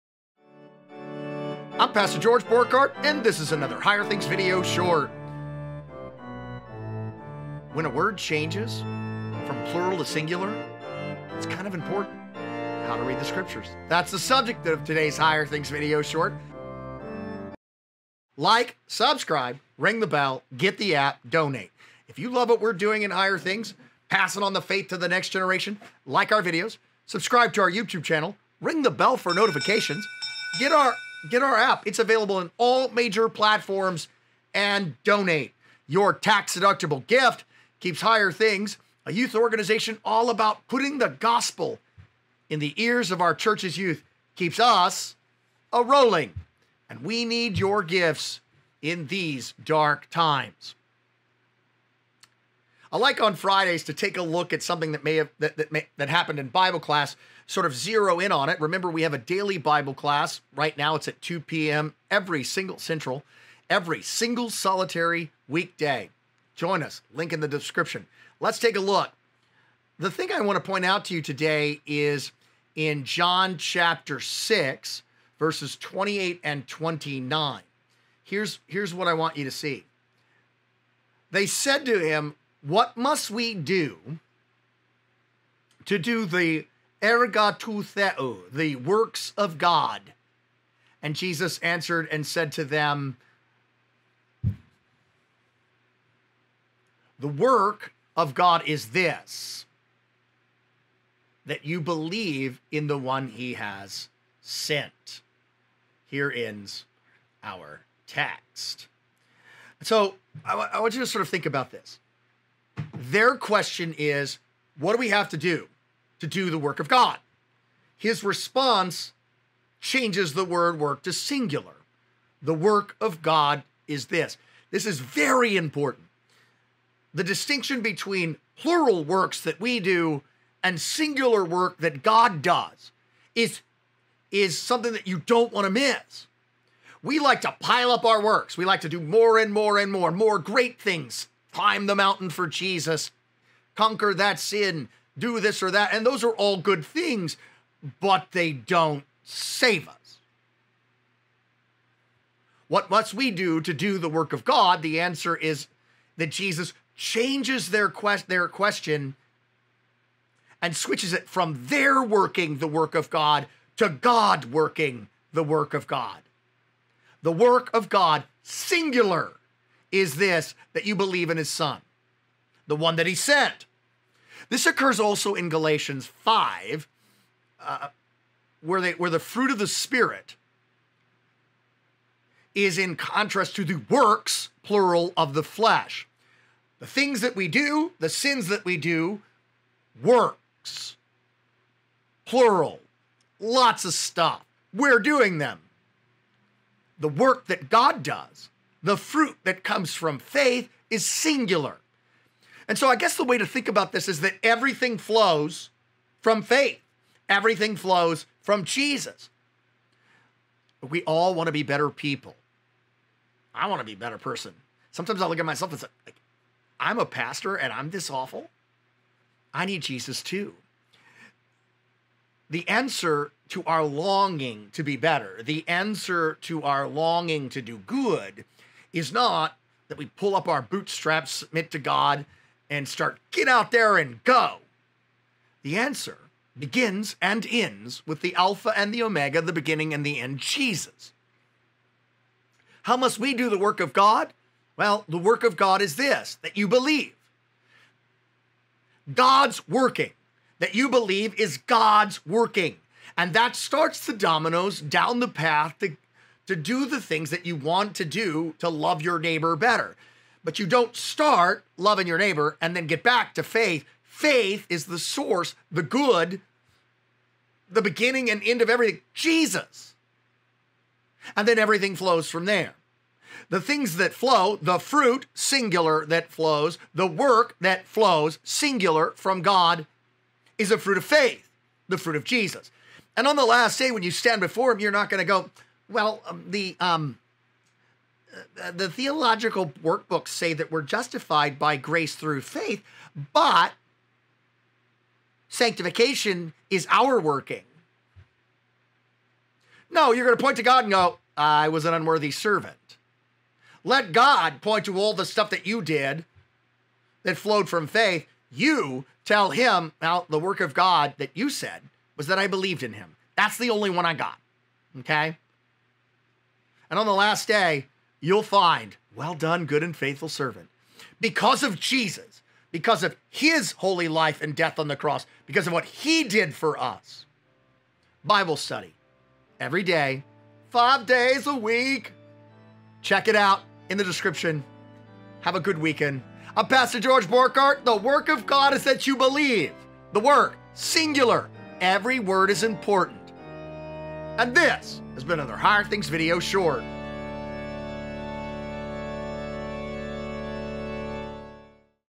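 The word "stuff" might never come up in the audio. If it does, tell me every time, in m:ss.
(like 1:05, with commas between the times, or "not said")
3:13, 5:05.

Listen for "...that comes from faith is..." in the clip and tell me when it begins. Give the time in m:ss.
3:19.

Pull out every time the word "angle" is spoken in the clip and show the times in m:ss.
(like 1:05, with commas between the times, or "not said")
not said.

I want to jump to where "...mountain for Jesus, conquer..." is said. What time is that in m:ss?
2:21.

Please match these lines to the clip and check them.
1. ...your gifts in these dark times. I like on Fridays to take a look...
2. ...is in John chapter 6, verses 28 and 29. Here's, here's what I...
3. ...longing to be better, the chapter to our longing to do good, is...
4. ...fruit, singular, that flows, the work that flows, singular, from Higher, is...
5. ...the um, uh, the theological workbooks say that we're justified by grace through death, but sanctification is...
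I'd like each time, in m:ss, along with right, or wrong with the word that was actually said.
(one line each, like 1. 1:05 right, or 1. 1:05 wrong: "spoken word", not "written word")
1. 0:47 right
2. 1:11 right
3. 3:43 wrong: "answer", not "chapter"
4. 4:34 wrong: "God", not "Higher"
5. 4:46 wrong: "faith", not "death".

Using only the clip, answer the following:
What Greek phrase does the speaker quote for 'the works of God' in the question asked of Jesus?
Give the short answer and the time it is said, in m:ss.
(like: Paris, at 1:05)
ergatu theo, at 1:27.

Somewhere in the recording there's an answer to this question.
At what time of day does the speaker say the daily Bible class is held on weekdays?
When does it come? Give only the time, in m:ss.
1:01.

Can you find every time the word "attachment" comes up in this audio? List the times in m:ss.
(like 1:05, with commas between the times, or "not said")
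not said.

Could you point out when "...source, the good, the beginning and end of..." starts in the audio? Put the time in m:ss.
4:24.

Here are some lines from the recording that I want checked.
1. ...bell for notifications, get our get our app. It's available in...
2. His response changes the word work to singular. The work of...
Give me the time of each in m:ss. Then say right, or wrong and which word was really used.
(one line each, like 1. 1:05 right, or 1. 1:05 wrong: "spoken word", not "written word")
1. 0:28 right
2. 1:57 right.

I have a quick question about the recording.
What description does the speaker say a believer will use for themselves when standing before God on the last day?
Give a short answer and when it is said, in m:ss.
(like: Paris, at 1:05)
an unworthy servant, at 5:01.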